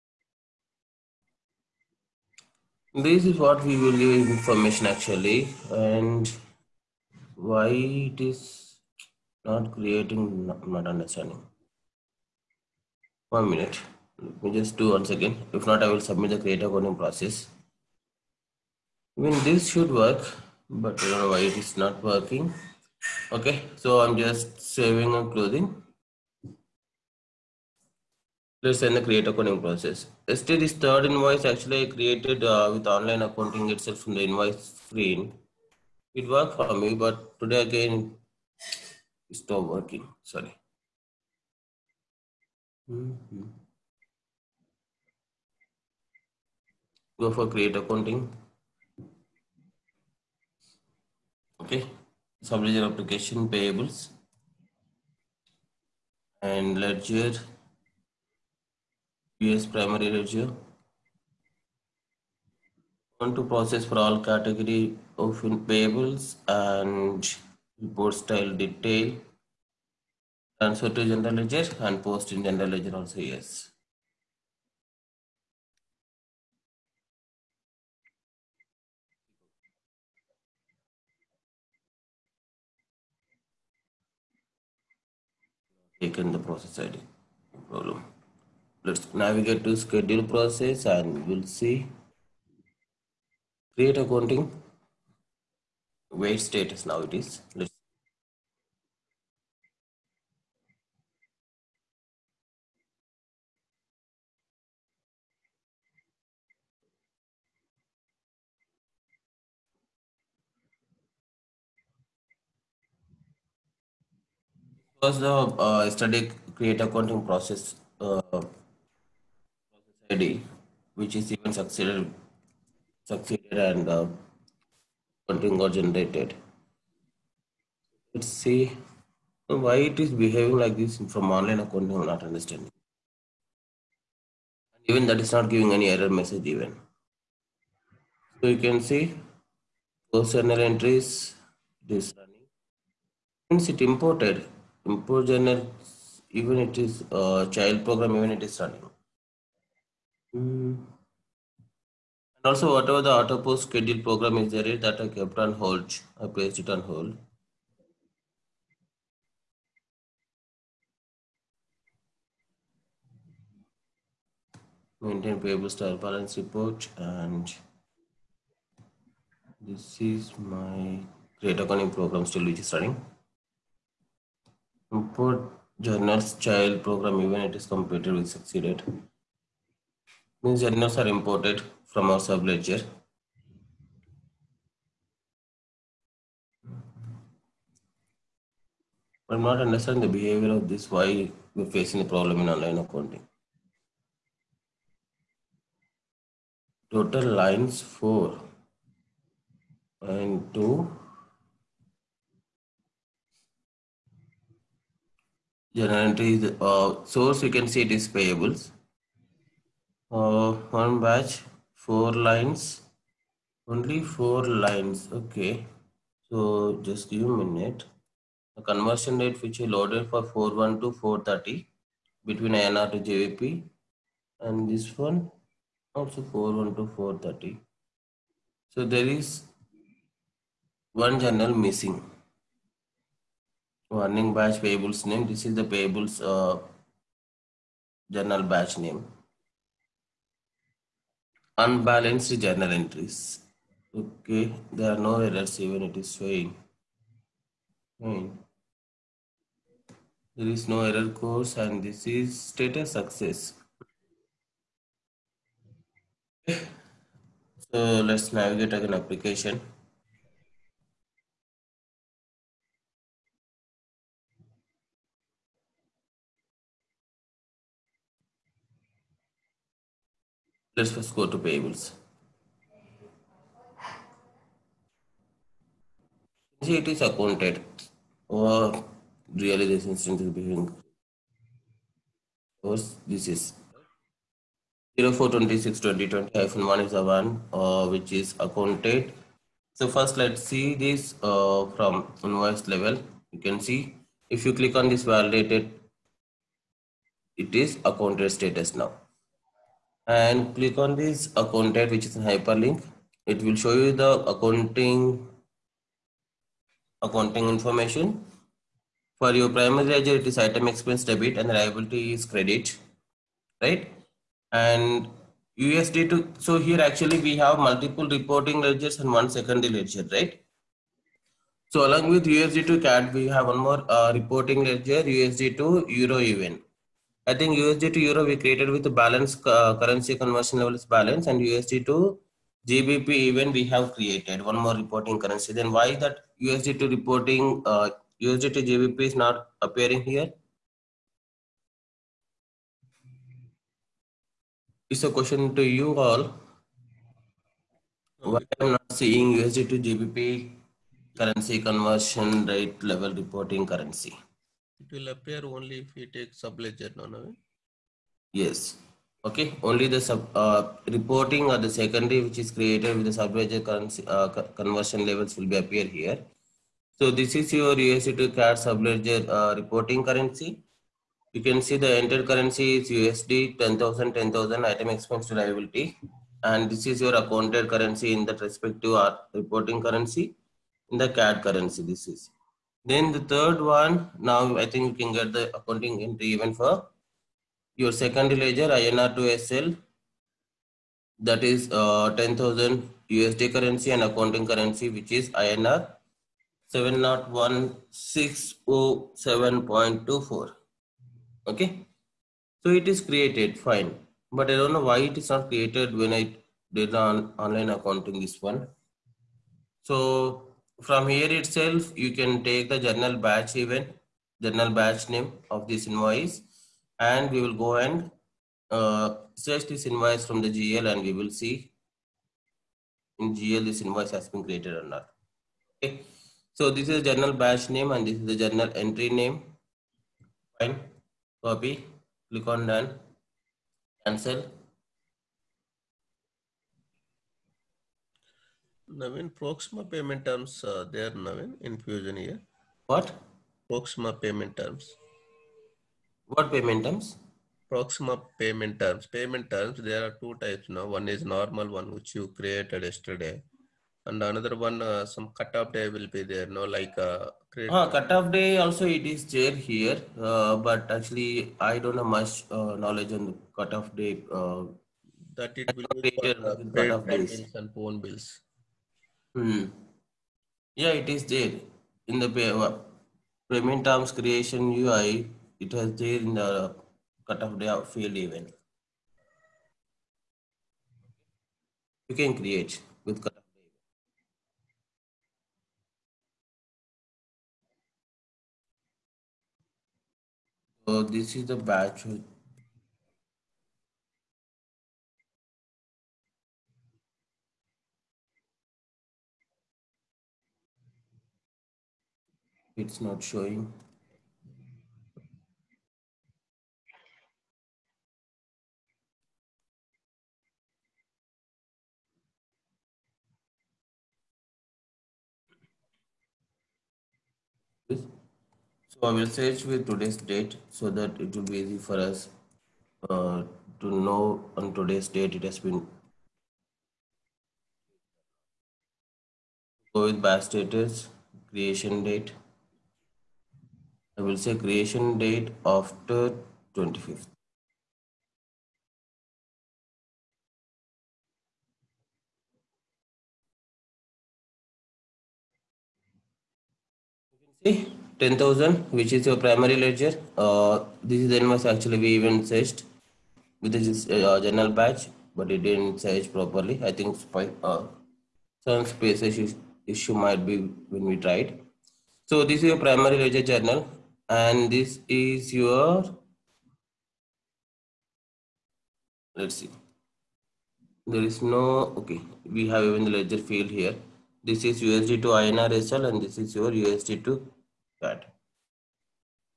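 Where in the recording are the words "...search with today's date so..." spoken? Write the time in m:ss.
8:39.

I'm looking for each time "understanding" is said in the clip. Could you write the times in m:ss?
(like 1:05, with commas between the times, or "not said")
0:10, 2:12, 3:09.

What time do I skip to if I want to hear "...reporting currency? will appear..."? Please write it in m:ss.
5:53.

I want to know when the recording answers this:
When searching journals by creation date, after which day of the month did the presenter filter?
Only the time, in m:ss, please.
8:55.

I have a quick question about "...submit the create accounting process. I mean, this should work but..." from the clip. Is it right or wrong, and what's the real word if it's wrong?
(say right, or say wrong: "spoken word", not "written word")
right.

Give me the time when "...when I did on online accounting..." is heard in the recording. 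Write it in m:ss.
6:45.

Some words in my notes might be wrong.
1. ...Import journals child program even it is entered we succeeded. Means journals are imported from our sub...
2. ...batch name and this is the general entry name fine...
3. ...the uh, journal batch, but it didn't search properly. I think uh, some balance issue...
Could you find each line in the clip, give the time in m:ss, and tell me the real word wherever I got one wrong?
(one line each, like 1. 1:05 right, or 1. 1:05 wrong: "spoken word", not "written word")
1. 2:54 wrong: "completed", not "entered"
2. 7:07 wrong: "journal", not "general"
3. 9:13 wrong: "space", not "balance".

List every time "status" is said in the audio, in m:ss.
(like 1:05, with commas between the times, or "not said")
1:36, 4:12, 4:58, 8:50.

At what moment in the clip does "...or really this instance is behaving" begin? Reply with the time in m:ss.
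4:38.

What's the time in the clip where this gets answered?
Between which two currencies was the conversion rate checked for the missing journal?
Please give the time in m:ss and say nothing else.
3:42.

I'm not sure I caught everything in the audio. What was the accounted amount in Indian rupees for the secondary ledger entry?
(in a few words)
INR 701,607.24.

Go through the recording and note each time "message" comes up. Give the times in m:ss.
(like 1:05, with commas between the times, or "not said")
2:16.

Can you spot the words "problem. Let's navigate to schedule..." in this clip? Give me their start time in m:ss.
1:27.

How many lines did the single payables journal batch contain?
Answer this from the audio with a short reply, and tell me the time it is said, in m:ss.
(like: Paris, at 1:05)
4, at 3:33.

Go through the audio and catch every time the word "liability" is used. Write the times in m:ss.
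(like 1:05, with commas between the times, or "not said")
5:11, 6:15.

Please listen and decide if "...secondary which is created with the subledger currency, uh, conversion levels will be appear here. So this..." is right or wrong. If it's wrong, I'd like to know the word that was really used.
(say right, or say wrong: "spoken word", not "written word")
right.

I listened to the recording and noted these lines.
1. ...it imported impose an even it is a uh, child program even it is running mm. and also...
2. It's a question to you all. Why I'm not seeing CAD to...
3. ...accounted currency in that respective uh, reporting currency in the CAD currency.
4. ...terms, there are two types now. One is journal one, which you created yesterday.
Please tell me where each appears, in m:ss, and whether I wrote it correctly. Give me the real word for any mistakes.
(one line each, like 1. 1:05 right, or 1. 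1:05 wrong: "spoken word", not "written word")
1. 2:23 right
2. 5:44 wrong: "USD", not "CAD"
3. 6:17 right
4. 7:29 wrong: "normal", not "journal".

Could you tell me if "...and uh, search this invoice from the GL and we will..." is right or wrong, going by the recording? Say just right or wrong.
right.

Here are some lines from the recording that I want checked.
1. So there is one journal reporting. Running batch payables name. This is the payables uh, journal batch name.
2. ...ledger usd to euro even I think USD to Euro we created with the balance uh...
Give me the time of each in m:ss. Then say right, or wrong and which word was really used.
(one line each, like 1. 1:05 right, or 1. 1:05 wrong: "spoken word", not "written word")
1. 3:48 wrong: "missing", not "reporting"
2. 5:24 right.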